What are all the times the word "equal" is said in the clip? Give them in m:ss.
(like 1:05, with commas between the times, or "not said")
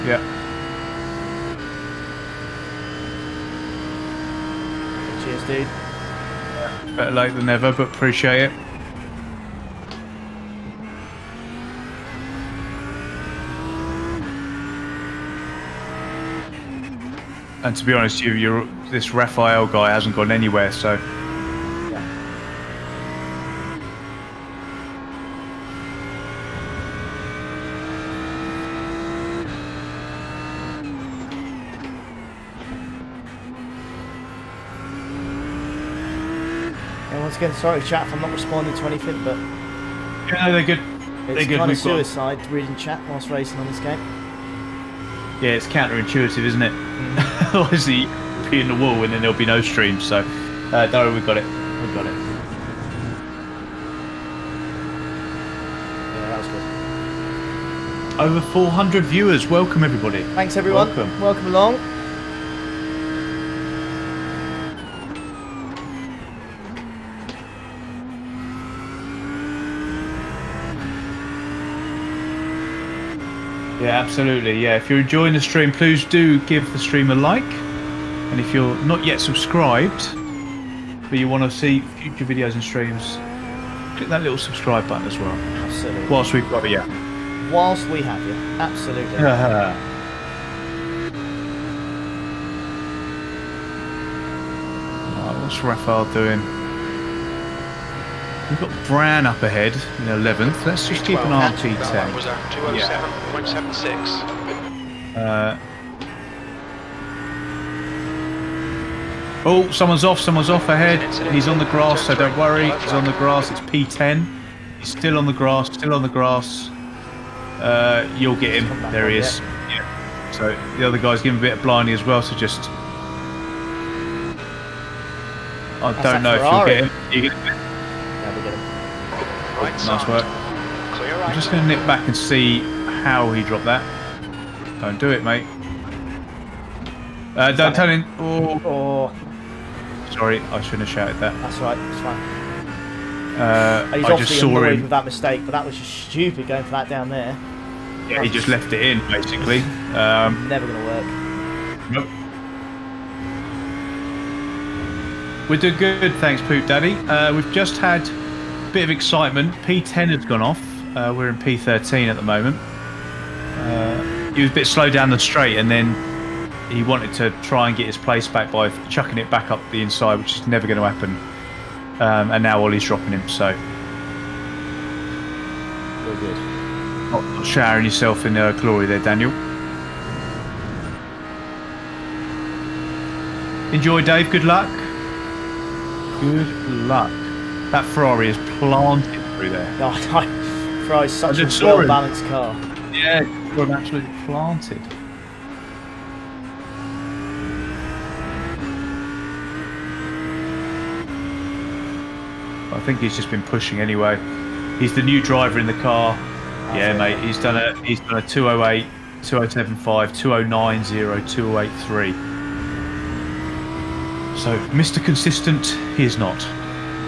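not said.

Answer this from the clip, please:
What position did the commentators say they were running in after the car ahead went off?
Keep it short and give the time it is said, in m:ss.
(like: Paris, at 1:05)
P13, at 2:41.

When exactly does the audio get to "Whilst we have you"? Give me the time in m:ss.
1:27.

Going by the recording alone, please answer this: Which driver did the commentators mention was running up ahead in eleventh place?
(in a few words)
Bram.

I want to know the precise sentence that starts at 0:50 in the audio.
So, uh, don't worry, we've got it.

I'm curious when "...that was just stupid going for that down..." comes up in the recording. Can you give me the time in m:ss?
2:25.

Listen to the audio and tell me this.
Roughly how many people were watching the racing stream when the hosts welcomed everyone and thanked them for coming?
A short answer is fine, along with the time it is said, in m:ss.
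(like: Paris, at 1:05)
Over 400, at 0:58.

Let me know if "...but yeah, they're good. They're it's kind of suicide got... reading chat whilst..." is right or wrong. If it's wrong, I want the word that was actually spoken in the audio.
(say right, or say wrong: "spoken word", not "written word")
right.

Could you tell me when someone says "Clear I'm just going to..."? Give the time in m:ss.
2:10.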